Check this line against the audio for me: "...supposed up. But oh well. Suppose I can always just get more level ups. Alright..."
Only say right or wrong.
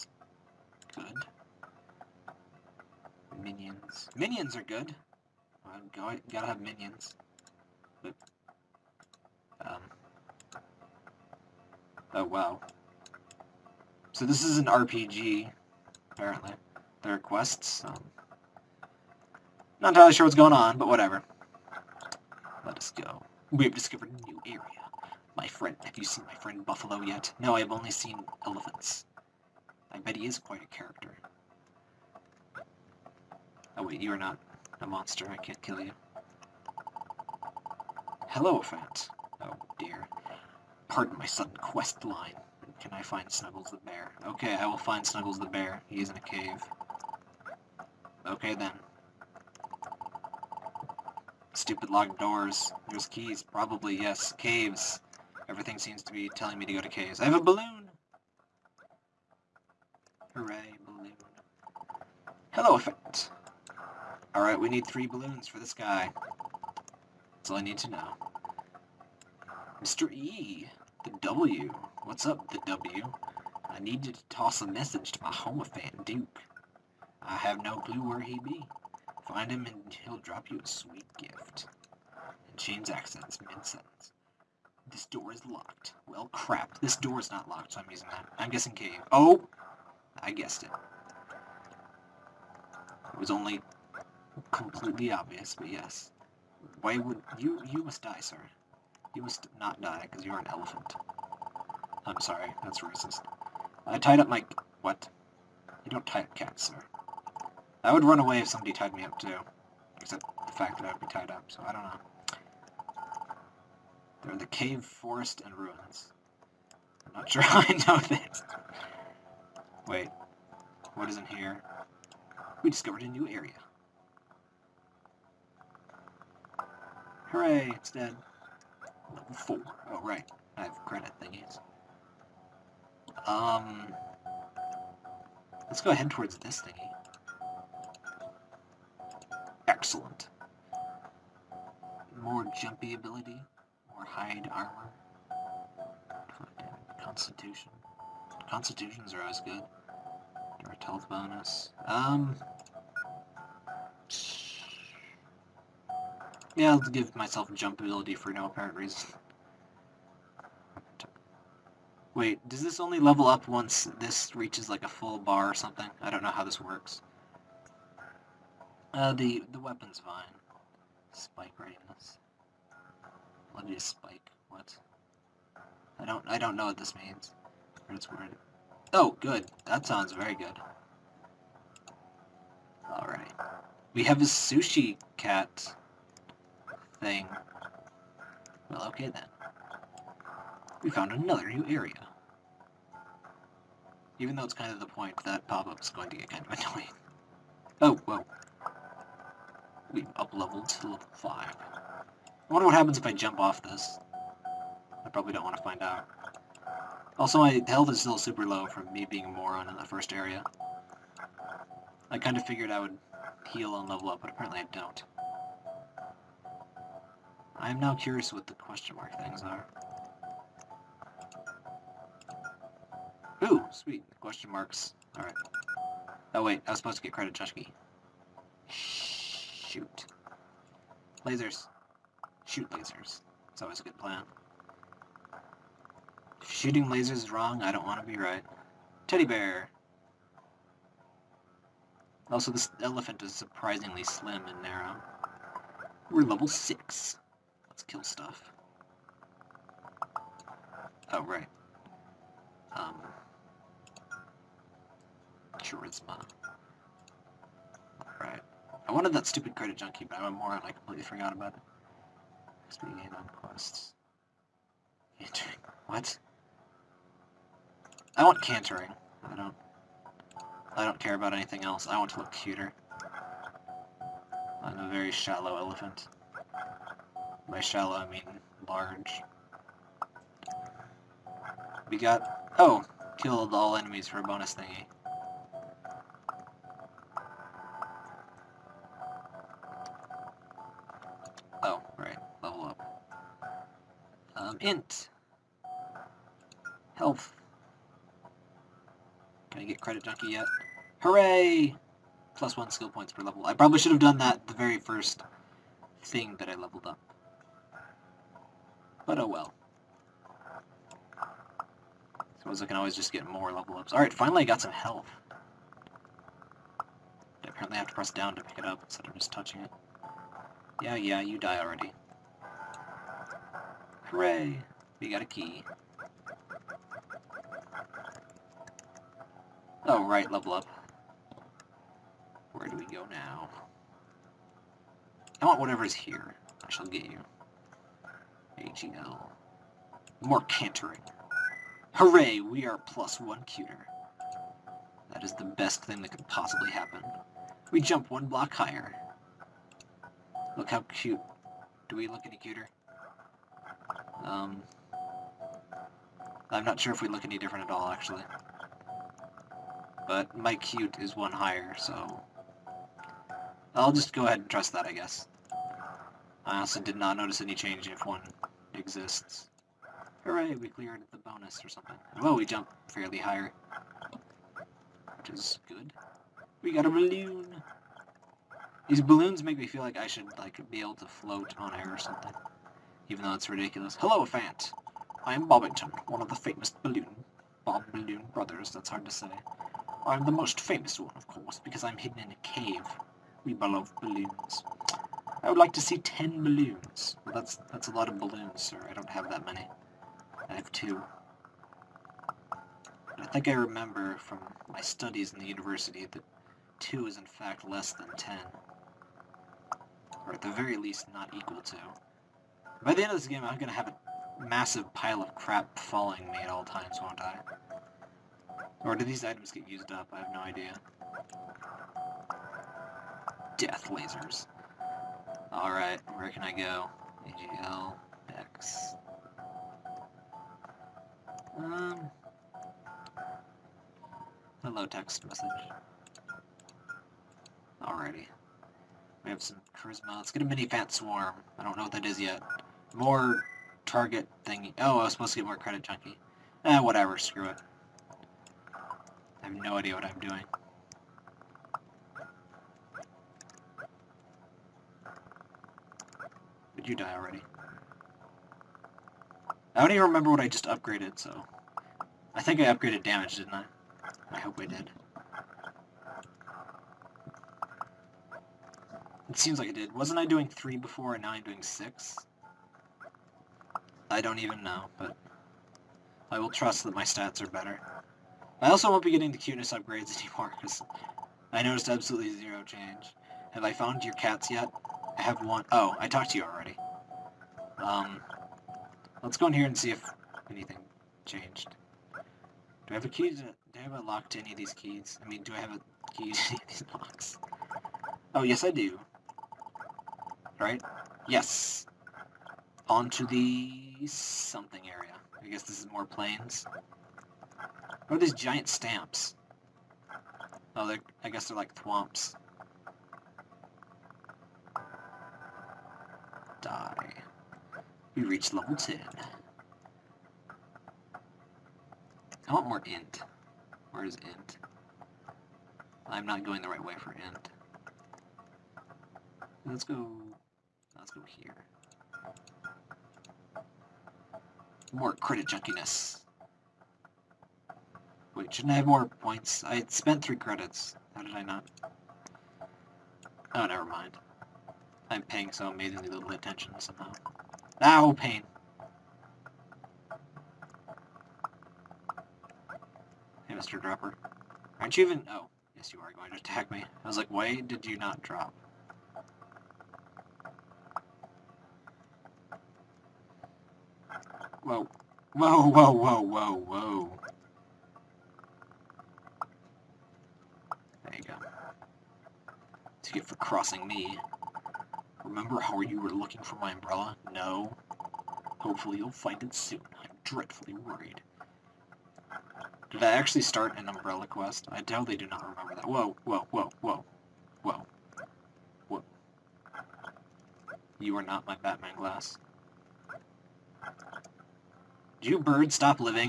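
wrong.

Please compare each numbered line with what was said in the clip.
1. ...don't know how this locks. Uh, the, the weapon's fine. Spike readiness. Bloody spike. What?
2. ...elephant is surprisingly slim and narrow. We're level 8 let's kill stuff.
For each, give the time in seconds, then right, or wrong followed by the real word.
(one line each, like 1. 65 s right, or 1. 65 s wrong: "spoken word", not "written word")
1. 166 s wrong: "works", not "locks"
2. 242 s wrong: "6", not "8".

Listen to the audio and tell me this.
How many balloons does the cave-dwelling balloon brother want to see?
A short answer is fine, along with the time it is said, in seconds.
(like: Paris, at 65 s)
10, at 395 s.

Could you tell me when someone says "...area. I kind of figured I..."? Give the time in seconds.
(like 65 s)
210 s.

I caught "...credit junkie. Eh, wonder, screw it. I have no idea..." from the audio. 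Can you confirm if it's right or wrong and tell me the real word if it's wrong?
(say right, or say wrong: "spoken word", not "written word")
wrong: "whatever", not "wonder".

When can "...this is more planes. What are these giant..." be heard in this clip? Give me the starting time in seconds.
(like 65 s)
505 s.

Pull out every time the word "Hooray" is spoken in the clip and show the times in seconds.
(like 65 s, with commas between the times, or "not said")
60 s, 127 s, 300 s, 324 s, 341 s, 370 s.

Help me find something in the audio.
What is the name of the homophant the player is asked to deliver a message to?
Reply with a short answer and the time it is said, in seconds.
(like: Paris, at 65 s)
Duke, at 76 s.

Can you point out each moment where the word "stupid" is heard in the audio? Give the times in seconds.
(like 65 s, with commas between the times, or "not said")
51 s, 259 s.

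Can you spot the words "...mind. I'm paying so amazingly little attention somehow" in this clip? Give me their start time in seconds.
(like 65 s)
543 s.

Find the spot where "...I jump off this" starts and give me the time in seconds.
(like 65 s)
203 s.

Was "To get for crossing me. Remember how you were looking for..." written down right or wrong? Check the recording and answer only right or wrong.
right.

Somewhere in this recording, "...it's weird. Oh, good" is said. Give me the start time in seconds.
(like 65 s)
177 s.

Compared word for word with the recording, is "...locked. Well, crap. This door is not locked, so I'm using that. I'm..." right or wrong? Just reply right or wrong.
right.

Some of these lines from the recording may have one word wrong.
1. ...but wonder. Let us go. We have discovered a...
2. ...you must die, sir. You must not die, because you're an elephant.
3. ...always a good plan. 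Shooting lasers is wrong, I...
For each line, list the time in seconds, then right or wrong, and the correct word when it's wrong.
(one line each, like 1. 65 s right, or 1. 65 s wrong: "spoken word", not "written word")
1. 20 s wrong: "whatever", not "wonder"
2. 97 s right
3. 233 s right.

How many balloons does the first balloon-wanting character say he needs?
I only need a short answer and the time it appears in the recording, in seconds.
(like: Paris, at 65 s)
3, at 64 s.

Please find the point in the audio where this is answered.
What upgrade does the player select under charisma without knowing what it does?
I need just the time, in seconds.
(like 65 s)
440 s.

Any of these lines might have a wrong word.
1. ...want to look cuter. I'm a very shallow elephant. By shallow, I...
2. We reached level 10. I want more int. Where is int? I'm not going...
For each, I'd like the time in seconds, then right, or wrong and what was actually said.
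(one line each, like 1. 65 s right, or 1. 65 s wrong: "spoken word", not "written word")
1. 271 s right
2. 518 s right.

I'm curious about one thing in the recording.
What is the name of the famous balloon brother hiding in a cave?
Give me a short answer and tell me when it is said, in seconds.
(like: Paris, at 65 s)
Bobbington, at 385 s.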